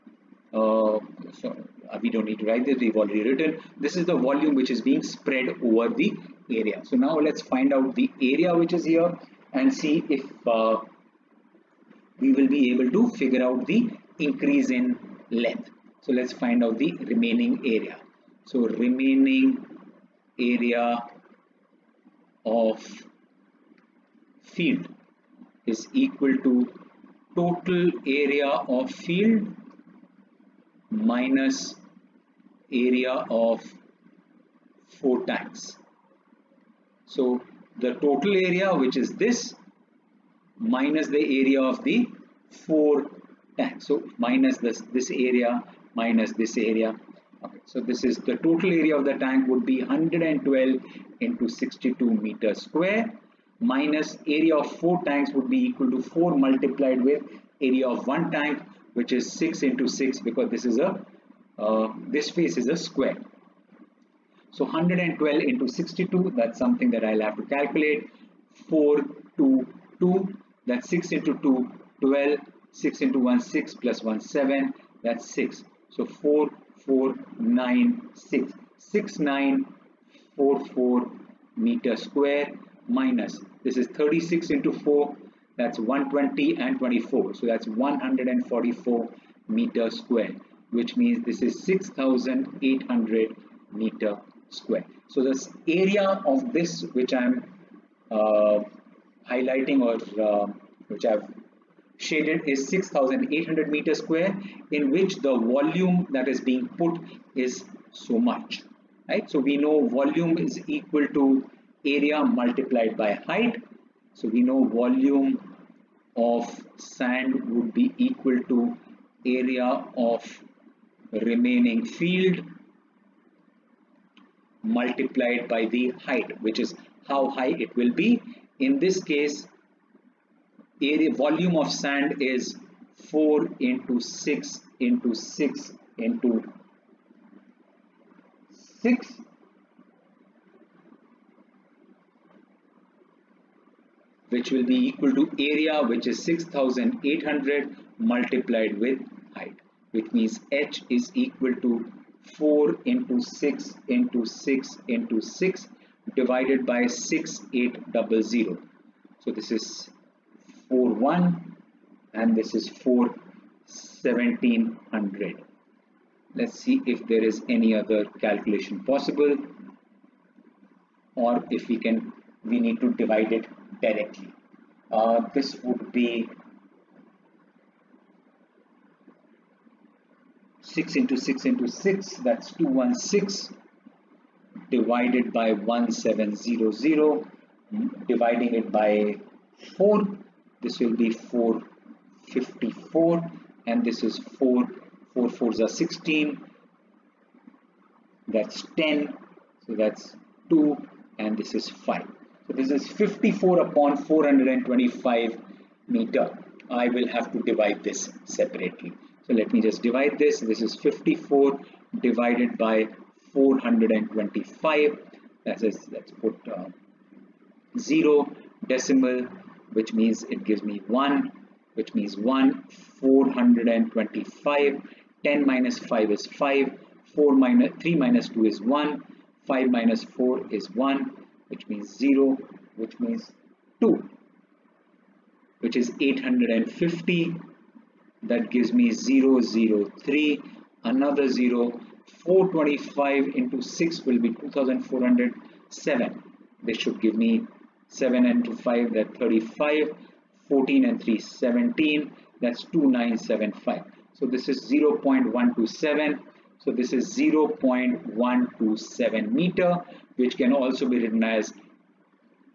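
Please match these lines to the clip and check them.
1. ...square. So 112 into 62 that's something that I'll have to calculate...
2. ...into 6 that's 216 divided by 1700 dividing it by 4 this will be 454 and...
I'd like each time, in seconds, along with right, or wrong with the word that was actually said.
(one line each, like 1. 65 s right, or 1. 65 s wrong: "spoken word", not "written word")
1. 62 s right
2. 181 s right.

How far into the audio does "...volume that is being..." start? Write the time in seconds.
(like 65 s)
105 s.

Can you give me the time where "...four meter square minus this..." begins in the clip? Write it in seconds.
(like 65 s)
80 s.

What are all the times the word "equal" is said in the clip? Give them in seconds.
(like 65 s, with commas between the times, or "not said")
25 s, 55 s, 110 s, 117 s, 144 s, 151 s.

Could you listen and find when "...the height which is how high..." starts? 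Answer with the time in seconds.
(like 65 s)
125 s.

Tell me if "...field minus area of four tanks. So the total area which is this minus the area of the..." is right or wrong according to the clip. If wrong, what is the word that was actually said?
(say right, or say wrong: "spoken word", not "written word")
right.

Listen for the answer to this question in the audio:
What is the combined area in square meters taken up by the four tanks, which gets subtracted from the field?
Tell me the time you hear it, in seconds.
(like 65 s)
87 s.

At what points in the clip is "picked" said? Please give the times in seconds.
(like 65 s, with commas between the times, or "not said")
not said.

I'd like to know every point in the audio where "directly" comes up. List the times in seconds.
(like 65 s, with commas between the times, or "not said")
173 s.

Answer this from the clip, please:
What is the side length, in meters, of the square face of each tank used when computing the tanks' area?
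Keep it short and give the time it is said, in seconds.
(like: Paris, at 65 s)
6, at 59 s.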